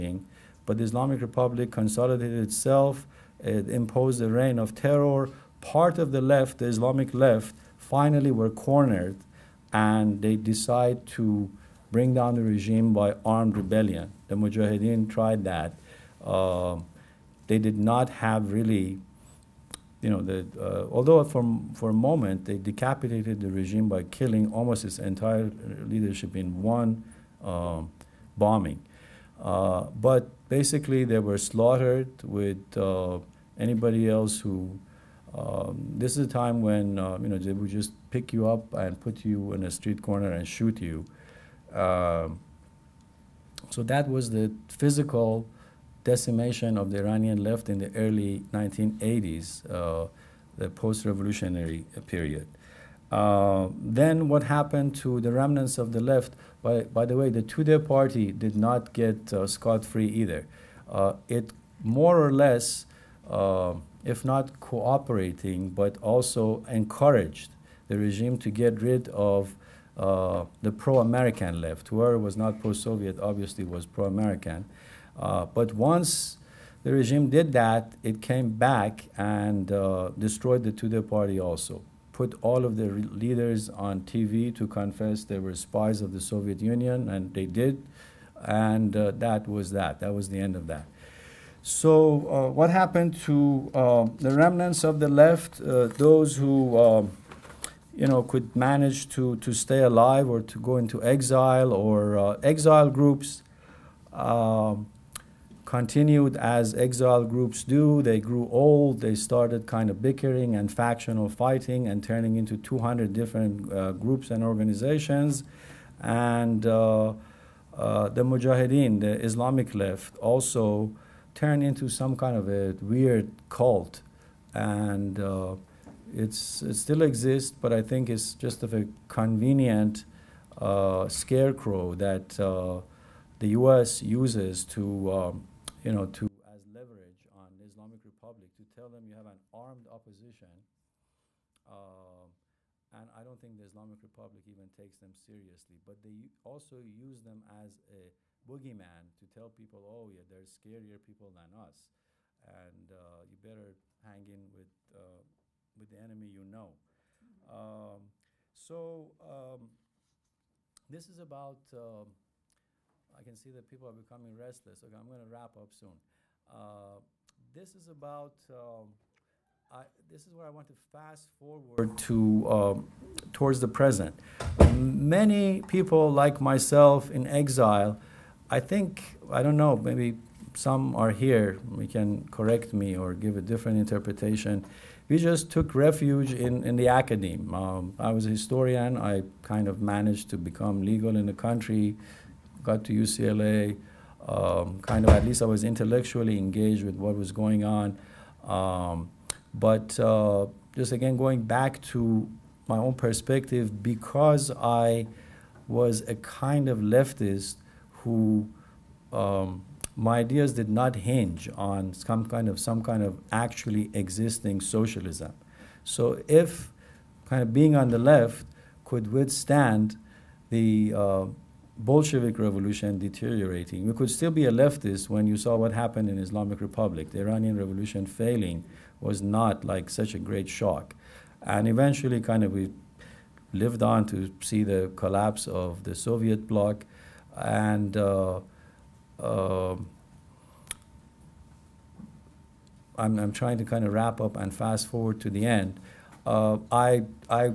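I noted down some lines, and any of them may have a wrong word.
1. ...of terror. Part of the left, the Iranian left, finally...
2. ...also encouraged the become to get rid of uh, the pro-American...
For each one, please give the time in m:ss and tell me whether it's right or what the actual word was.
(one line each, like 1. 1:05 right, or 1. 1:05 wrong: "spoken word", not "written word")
1. 0:04 wrong: "Islamic", not "Iranian"
2. 1:06 wrong: "regime", not "become".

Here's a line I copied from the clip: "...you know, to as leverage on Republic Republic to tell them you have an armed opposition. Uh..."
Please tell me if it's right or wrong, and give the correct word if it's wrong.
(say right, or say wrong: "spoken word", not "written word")
wrong: "Islamic", not "Republic".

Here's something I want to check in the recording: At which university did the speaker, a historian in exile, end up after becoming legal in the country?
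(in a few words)
UCLA.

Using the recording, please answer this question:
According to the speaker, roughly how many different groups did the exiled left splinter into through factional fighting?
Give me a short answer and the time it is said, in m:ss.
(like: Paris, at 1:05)
200, at 1:52.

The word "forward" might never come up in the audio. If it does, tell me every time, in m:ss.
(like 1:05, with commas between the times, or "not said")
2:51, 4:04.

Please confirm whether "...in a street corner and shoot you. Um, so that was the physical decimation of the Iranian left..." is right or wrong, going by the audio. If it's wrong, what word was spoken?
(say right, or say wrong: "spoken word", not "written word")
right.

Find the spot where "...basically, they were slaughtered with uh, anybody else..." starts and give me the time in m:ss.
0:30.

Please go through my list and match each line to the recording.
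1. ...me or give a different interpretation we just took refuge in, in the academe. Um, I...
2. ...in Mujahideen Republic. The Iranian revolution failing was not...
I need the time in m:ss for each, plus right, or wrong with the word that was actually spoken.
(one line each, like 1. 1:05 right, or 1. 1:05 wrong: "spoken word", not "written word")
1. 3:02 right
2. 3:46 wrong: "Islamic", not "Mujahideen".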